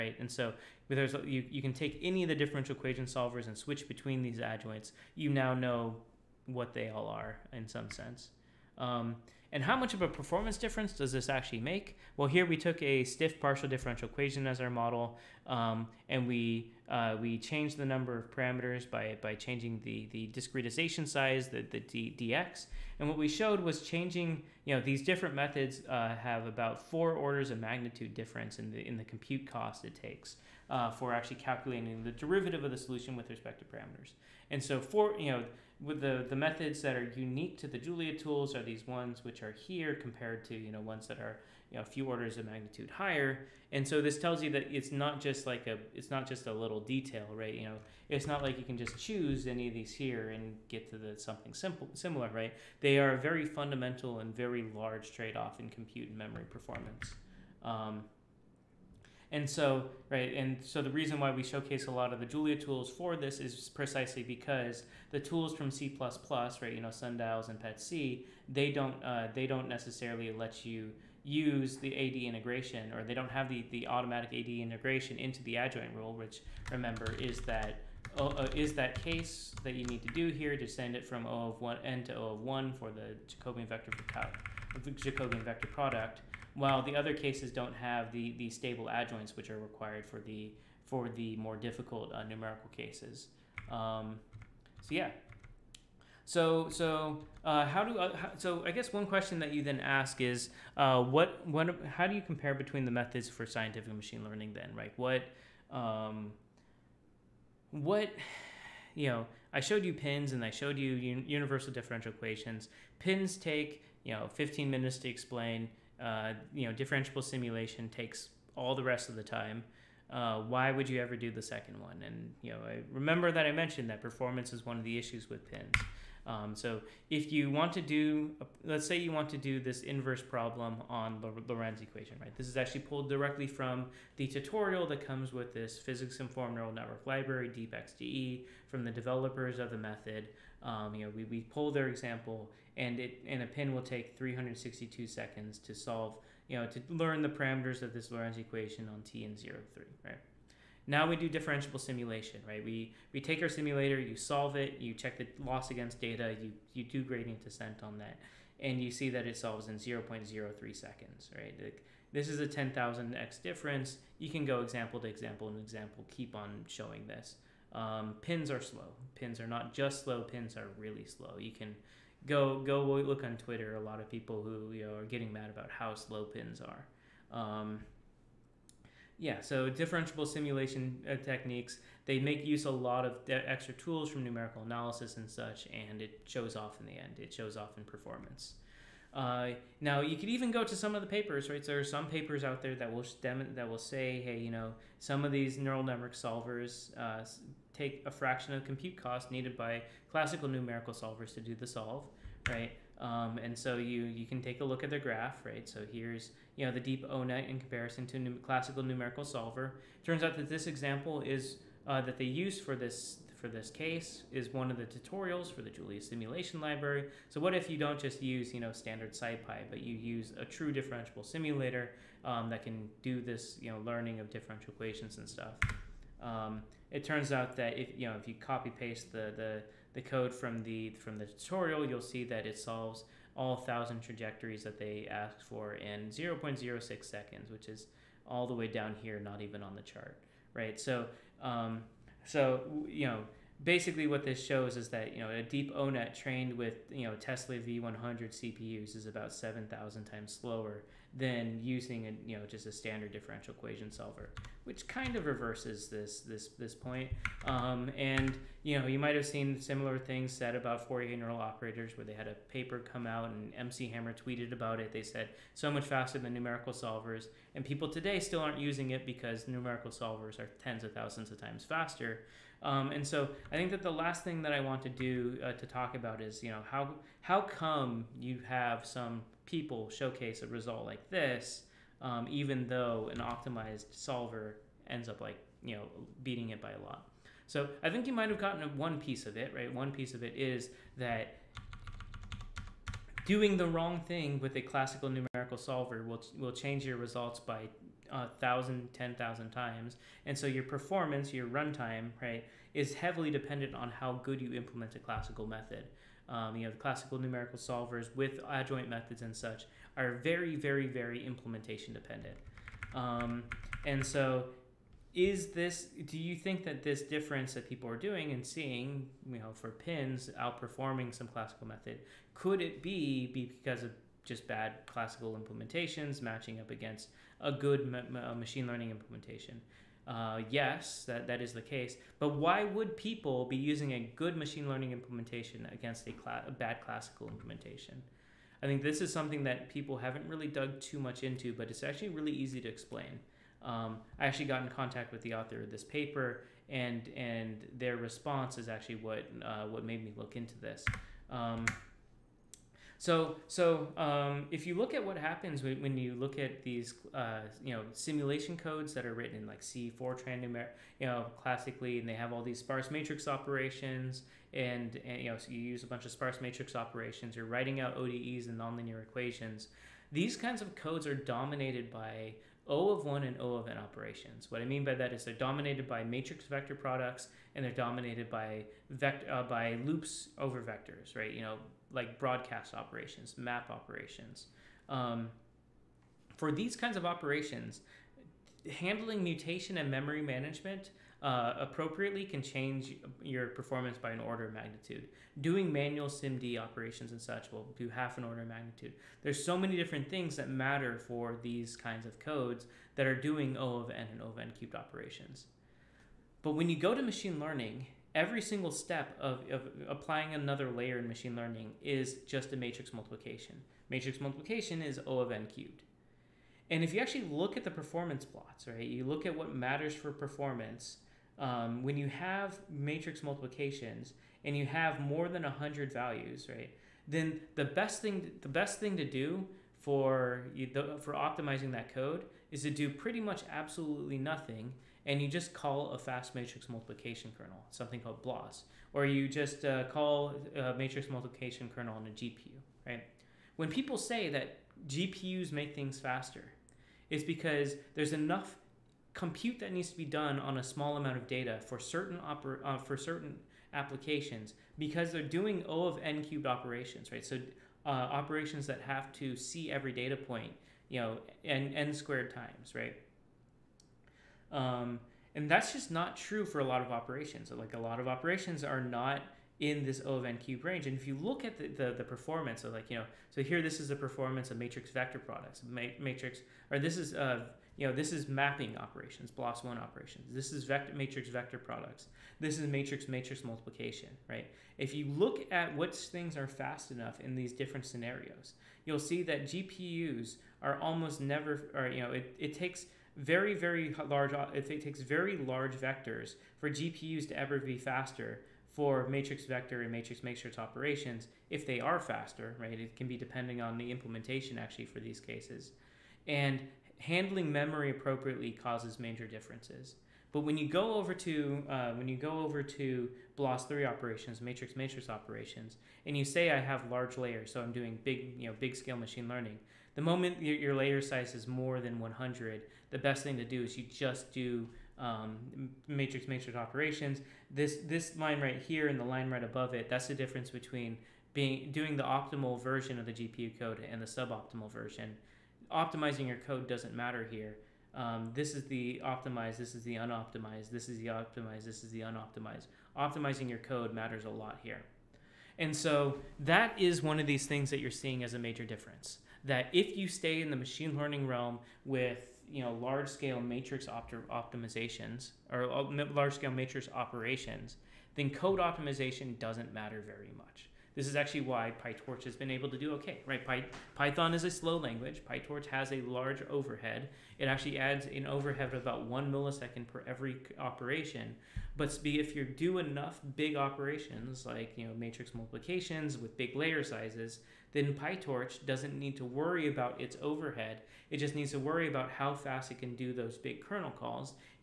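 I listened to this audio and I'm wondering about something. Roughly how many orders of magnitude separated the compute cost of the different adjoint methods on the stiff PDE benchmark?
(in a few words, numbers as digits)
4.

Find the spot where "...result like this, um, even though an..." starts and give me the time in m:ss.
4:40.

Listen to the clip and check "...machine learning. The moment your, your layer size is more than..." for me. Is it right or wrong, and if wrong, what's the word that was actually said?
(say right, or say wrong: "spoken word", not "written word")
right.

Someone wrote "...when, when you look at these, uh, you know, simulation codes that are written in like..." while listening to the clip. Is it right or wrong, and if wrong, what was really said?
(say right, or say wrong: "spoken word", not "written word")
right.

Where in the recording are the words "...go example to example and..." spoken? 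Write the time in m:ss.
2:44.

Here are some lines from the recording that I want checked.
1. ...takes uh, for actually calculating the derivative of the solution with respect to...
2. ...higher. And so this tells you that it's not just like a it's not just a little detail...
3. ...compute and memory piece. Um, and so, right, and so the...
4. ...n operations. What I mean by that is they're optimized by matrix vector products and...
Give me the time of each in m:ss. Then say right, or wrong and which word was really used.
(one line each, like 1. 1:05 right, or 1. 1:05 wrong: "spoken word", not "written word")
1. 0:29 right
2. 0:42 right
3. 0:55 wrong: "performance", not "piece"
4. 6:13 wrong: "dominated", not "optimized".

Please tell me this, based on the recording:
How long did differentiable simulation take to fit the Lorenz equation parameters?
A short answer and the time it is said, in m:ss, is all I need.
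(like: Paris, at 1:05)
0.03 seconds, at 2:39.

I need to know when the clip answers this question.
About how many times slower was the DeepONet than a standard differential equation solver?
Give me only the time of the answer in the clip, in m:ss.
4:09.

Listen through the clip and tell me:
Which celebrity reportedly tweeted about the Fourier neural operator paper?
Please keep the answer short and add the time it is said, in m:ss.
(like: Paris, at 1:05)
MC Hammer, at 4:23.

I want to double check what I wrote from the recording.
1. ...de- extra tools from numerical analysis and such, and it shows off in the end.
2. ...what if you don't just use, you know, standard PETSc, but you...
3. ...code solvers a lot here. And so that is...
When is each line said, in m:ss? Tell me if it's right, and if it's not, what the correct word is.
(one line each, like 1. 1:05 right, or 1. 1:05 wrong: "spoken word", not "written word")
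1. 3:03 right
2. 3:37 wrong: "SciPy", not "PETSc"
3. 9:03 wrong: "matters", not "solvers".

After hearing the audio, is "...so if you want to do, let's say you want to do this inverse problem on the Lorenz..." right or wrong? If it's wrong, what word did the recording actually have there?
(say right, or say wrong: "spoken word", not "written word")
right.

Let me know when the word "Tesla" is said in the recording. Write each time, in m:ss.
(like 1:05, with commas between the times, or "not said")
4:07.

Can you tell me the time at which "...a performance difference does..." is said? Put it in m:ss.
0:10.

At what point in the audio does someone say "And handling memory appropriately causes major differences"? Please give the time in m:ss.
8:26.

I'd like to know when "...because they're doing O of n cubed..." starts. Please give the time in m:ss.
7:34.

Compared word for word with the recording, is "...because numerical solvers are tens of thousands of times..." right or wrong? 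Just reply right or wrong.
right.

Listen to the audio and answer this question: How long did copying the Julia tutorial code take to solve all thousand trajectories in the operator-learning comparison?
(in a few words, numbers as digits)
0.06 seconds.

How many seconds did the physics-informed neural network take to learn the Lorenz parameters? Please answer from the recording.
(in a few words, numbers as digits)
362.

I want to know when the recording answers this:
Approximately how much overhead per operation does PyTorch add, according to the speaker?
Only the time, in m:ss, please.
9:29.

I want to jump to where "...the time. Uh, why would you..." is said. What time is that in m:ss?
1:59.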